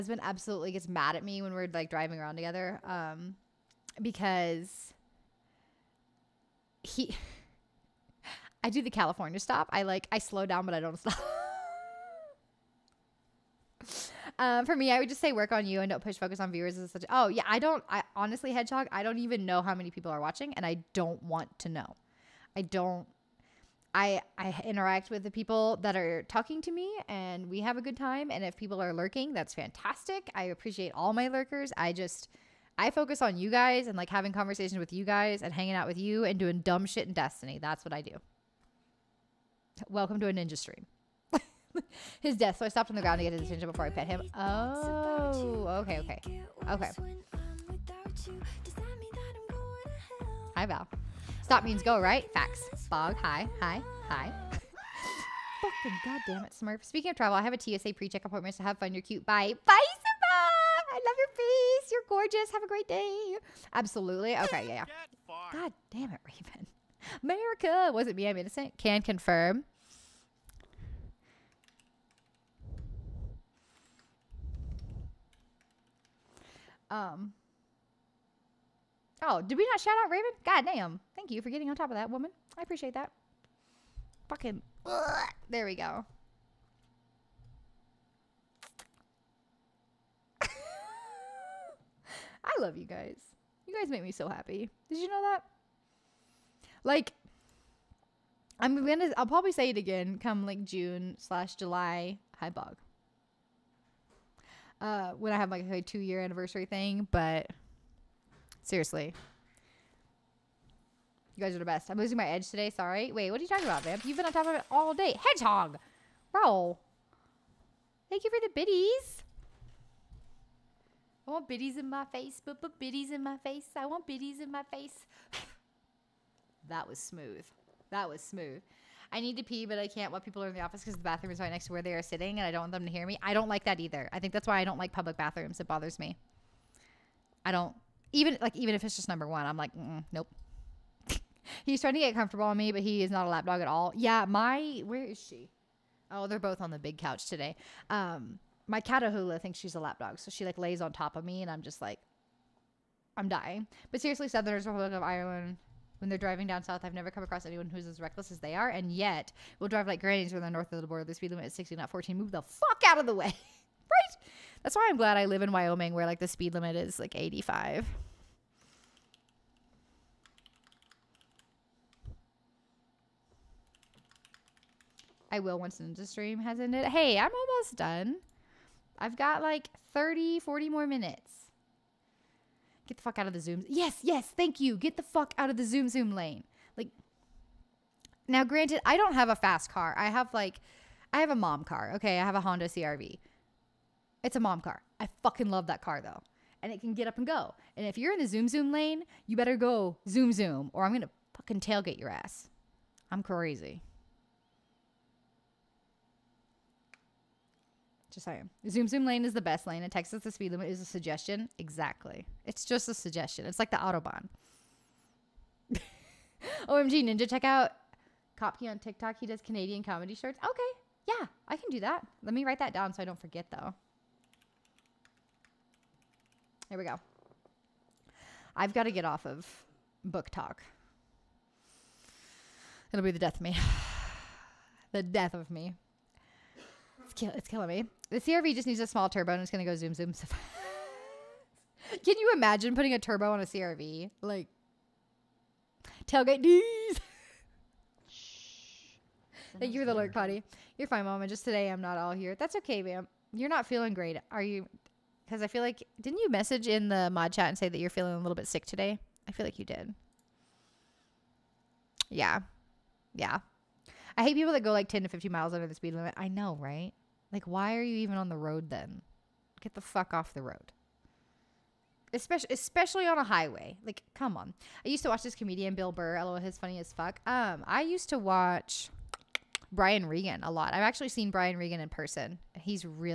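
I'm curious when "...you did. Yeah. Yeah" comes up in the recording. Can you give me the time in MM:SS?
04:19.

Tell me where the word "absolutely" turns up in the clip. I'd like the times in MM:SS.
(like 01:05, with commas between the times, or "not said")
00:00, 01:03.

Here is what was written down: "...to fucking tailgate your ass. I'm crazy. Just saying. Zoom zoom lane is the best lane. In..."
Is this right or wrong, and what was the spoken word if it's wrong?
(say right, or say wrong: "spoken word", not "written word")
right.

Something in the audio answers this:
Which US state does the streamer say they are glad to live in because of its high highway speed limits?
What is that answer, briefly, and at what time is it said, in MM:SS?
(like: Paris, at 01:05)
Wyoming, at 02:45.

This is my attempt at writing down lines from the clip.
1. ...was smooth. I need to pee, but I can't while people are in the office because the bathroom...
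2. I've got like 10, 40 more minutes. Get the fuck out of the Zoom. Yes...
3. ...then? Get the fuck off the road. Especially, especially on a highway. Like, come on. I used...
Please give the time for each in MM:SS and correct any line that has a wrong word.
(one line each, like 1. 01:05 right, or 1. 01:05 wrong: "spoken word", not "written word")
1. 02:08 right
2. 02:58 wrong: "30", not "10"
3. 04:28 right.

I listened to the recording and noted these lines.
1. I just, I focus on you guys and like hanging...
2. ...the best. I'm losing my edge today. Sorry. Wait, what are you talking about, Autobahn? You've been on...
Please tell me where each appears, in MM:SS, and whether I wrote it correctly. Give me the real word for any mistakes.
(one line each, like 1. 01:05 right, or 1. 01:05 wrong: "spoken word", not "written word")
1. 00:31 wrong: "having", not "hanging"
2. 01:51 wrong: "Vamp", not "Autobahn".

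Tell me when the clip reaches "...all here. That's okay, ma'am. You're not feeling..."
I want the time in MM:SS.
04:11.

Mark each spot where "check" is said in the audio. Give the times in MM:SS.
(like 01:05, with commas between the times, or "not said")
00:57, 03:37.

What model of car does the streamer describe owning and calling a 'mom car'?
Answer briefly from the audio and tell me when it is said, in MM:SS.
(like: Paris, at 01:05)
Honda CRV, at 03:12.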